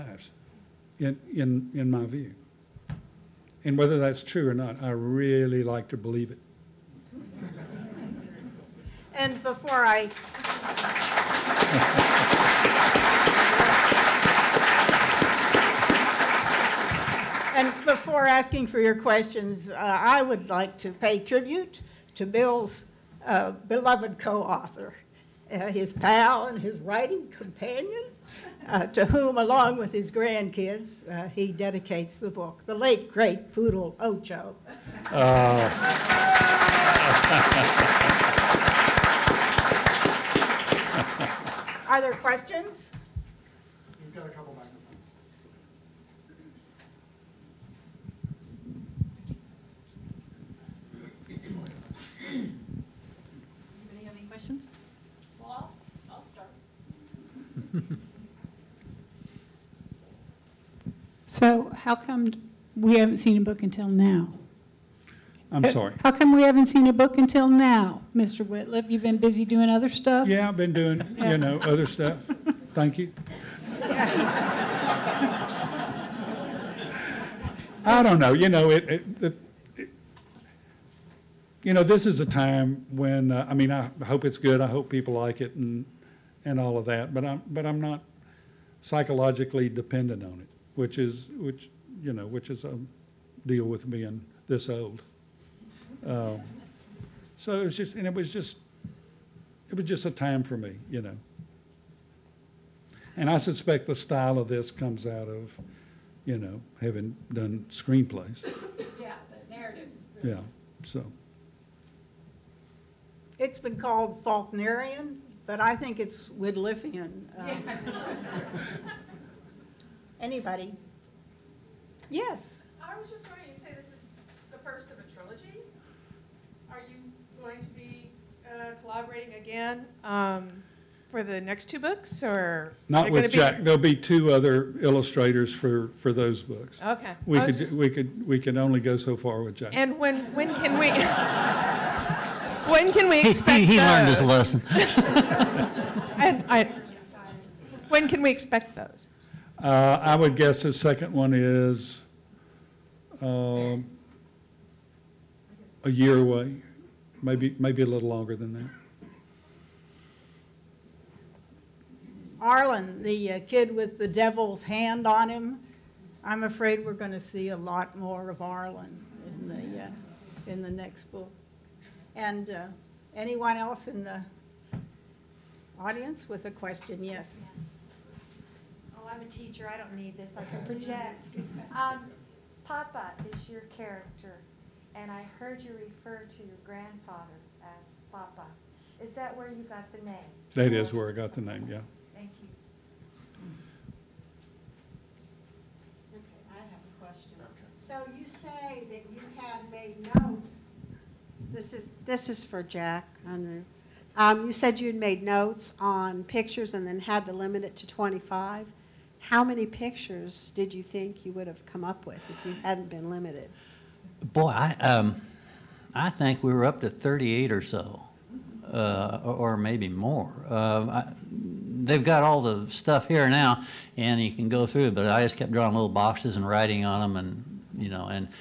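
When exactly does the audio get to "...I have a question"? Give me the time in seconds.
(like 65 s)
196 s.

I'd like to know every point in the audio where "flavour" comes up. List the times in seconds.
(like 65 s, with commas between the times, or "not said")
not said.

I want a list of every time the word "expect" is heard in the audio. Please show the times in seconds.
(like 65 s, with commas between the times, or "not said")
143 s, 148 s.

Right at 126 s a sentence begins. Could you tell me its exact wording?
Are you going to be uh, collaborating again um, for the next two books, or not with Jack?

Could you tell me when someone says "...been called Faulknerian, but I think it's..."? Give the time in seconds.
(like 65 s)
113 s.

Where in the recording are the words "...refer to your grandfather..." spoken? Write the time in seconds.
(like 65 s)
185 s.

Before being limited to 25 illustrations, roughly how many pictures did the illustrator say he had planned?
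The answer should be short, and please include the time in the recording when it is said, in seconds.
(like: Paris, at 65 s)
38, at 216 s.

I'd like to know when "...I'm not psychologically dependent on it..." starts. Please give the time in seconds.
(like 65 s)
87 s.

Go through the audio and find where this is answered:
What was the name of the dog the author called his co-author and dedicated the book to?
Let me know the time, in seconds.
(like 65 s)
33 s.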